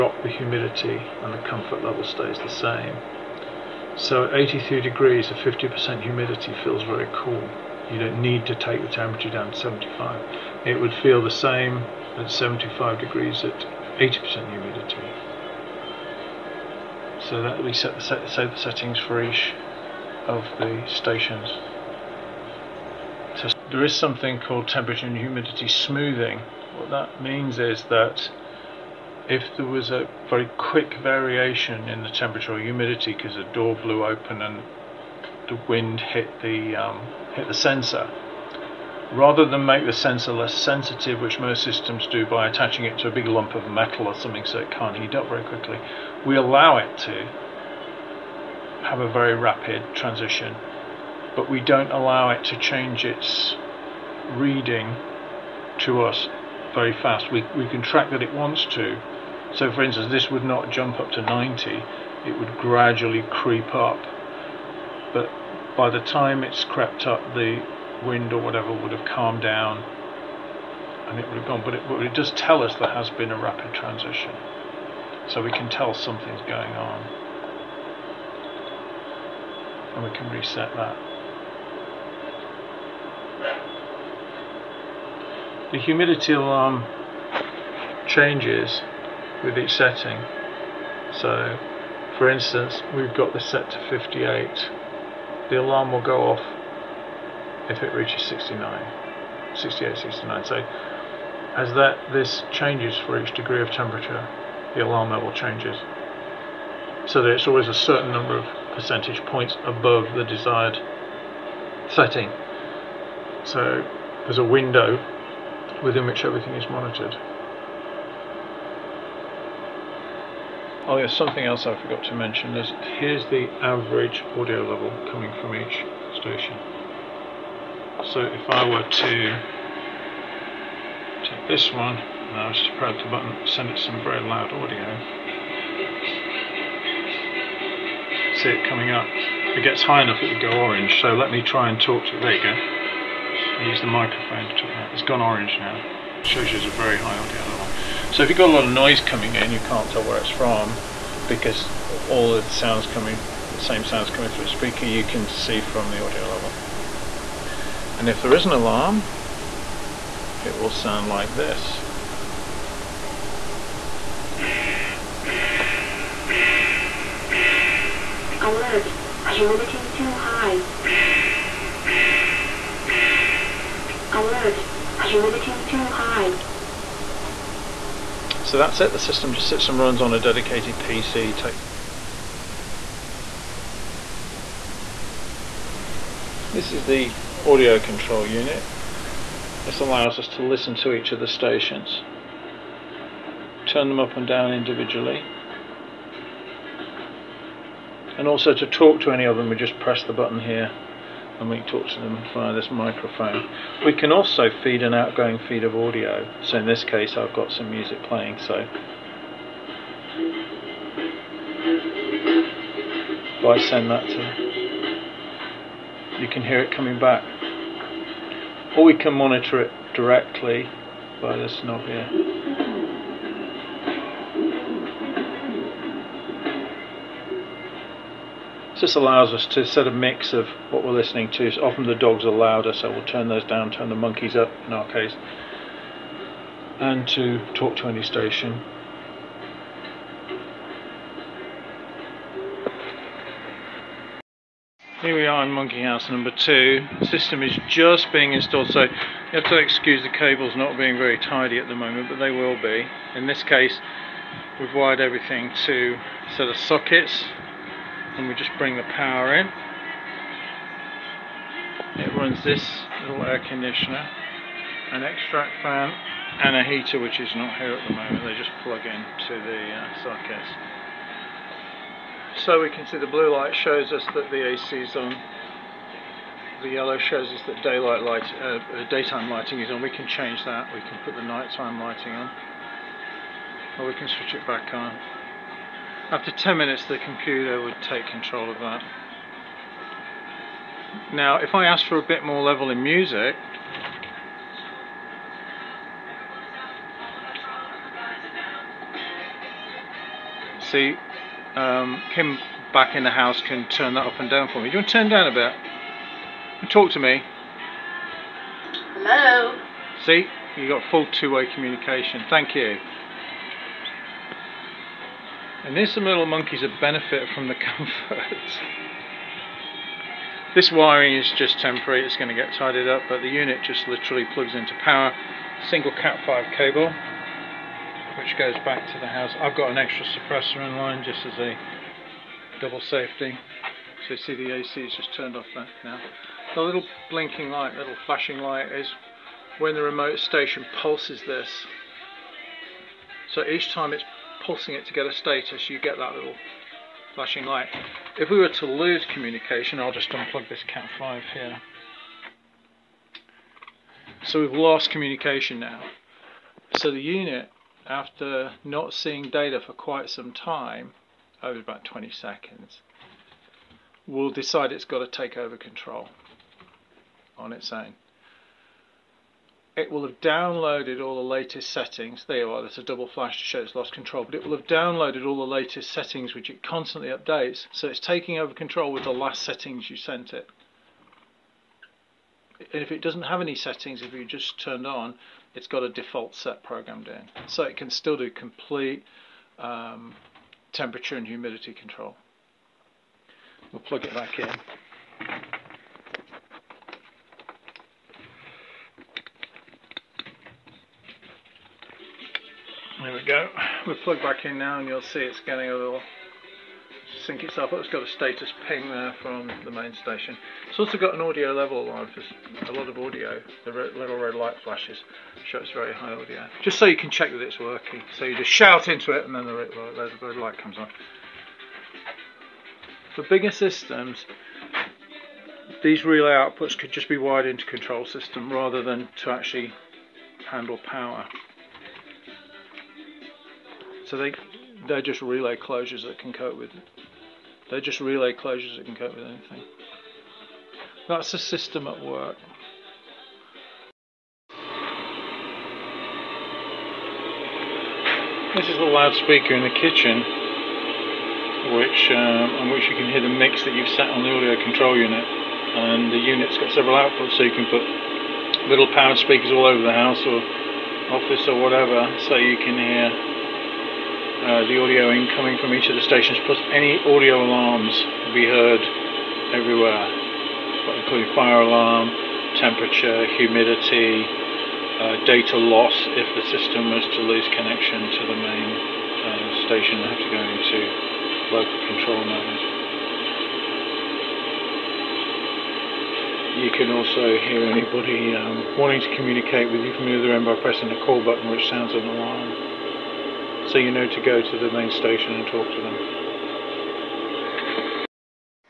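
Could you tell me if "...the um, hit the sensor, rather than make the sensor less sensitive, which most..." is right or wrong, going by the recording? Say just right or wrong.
right.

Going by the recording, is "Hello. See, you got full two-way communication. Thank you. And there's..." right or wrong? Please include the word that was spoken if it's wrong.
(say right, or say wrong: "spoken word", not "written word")
right.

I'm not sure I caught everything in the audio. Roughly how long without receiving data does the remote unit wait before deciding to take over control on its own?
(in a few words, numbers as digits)
20 seconds.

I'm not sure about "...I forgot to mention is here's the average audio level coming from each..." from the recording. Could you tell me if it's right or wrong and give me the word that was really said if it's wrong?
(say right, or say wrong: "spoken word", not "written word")
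right.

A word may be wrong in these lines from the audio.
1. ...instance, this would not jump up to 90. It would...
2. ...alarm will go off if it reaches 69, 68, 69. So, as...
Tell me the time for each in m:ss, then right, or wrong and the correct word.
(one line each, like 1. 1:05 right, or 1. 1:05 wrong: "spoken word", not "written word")
1. 0:59 right
2. 1:35 right.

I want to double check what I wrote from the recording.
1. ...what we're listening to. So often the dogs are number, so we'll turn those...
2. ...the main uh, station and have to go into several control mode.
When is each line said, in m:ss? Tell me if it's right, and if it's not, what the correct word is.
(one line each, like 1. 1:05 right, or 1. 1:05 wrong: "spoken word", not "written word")
1. 3:50 wrong: "louder", not "number"
2. 7:58 wrong: "local", not "several".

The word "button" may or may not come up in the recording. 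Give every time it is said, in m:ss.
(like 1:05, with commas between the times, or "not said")
2:13, 3:20, 8:11.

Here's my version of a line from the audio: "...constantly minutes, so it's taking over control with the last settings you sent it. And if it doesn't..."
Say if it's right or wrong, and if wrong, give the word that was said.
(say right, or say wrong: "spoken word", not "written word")
wrong: "updates", not "minutes".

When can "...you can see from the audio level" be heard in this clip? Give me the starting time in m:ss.
2:34.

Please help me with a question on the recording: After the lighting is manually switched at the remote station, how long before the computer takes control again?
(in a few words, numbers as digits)
10 minutes.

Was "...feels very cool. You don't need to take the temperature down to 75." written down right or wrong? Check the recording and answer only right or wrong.
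right.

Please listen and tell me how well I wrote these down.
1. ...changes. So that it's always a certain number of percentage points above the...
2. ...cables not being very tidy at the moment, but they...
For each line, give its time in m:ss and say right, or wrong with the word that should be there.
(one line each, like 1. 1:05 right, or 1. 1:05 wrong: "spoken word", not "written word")
1. 1:45 right
2. 4:10 right.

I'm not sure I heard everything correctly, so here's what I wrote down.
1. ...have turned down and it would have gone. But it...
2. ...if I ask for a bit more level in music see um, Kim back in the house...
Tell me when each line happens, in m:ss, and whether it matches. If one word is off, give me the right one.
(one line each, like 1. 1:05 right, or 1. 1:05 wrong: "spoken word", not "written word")
1. 1:08 wrong: "calmed", not "turned"
2. 4:51 right.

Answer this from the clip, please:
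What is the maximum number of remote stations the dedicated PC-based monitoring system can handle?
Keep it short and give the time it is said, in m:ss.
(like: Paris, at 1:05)
5, at 3:01.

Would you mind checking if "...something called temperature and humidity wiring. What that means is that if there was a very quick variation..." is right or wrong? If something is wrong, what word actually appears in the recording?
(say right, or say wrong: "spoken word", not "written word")
wrong: "smoothing", not "wiring".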